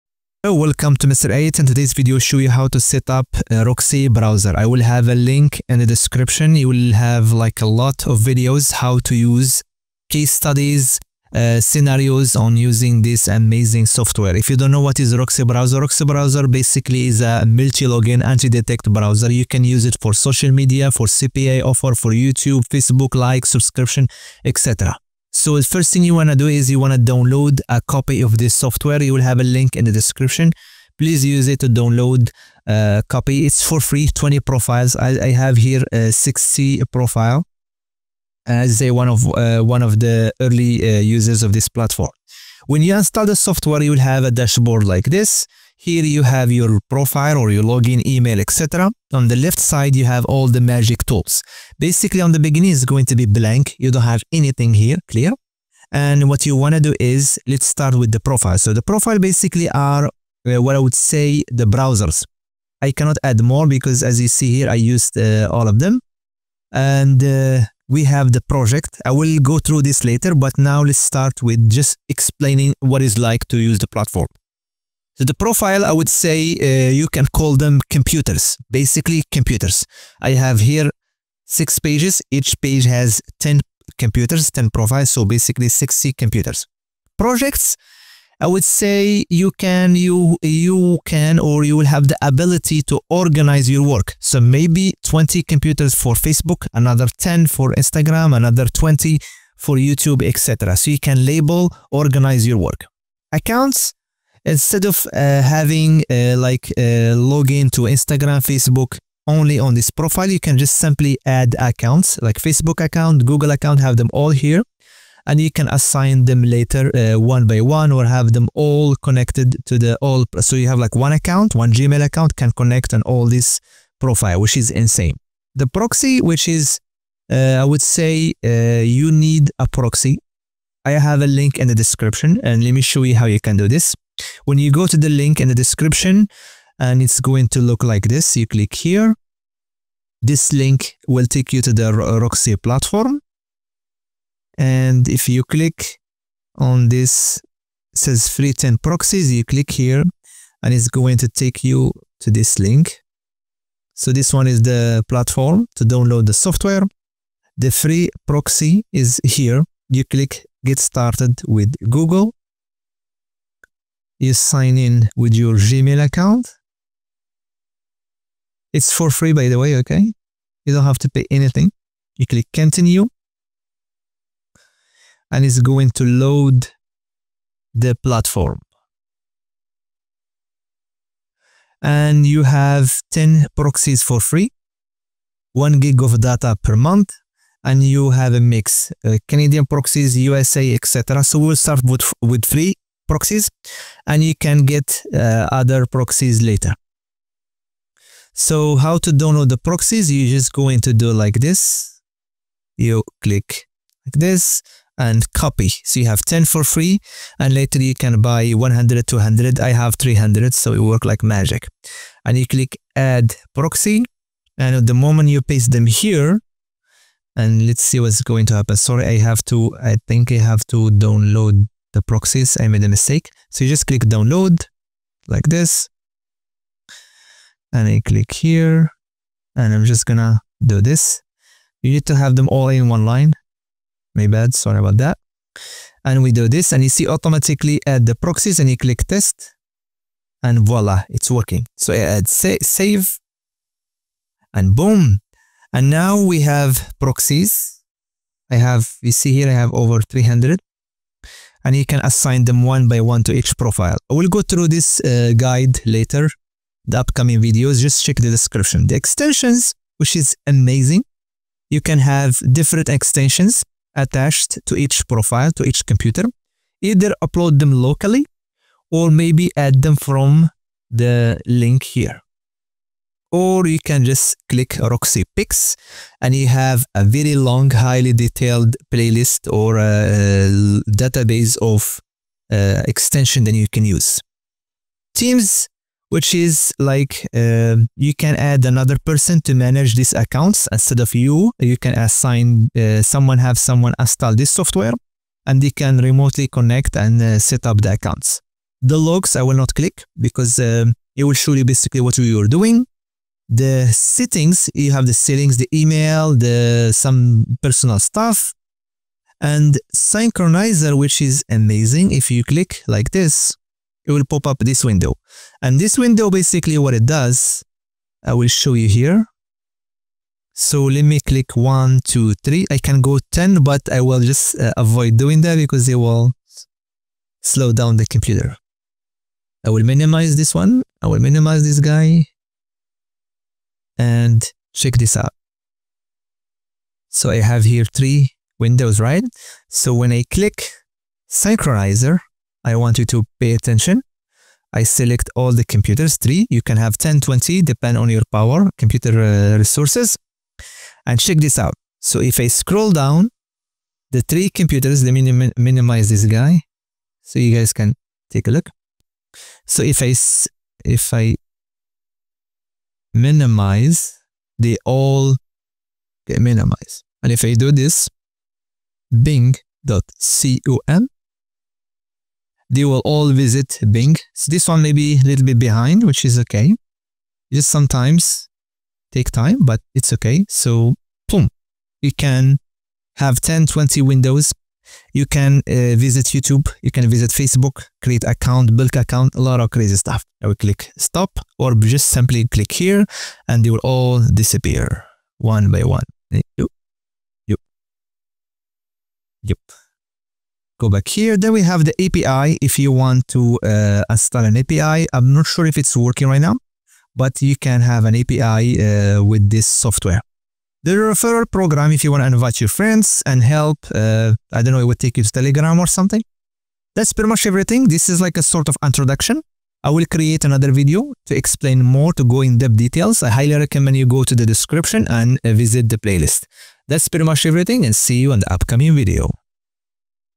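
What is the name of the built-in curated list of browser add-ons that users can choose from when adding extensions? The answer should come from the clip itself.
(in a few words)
Roxy Picks.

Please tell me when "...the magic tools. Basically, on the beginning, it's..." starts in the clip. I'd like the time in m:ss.
0:50.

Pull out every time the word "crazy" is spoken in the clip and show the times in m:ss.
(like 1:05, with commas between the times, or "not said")
6:29.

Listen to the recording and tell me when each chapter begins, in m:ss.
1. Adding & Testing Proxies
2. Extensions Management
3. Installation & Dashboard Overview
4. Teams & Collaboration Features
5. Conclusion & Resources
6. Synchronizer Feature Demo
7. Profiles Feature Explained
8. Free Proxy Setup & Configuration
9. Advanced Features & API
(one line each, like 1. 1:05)
1. 3:48
2. 4:15
3. 0:26
4. 4:42
5. 7:05
6. 5:05
7. 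0:53
8. 1:35
9. 6:30.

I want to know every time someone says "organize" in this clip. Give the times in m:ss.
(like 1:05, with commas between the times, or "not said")
1:33, 1:41.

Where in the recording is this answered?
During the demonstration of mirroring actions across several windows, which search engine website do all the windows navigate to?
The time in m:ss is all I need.
6:09.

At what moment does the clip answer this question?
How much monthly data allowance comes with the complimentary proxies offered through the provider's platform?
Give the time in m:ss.
3:05.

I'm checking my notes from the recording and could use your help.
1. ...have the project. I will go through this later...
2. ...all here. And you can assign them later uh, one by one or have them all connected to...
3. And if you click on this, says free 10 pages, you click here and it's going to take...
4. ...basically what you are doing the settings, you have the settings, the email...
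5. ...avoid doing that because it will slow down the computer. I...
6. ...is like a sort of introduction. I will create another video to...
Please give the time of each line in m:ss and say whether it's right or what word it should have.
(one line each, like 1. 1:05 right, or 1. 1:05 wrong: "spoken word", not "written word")
1. 1:08 right
2. 1:54 right
3. 2:24 wrong: "proxies", not "pages"
4. 5:01 right
5. 5:24 right
6. 6:58 right.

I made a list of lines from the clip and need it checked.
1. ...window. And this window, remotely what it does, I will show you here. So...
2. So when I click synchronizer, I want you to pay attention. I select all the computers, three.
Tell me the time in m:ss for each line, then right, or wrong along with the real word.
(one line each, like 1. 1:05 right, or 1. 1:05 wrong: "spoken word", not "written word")
1. 5:14 wrong: "basically", not "remotely"
2. 5:39 right.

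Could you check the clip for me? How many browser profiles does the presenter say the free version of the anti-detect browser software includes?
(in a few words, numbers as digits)
20.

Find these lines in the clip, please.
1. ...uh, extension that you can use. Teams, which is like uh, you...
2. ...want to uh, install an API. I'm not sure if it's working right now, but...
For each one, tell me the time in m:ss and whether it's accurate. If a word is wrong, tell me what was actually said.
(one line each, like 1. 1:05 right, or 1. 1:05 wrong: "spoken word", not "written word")
1. 4:42 right
2. 6:42 right.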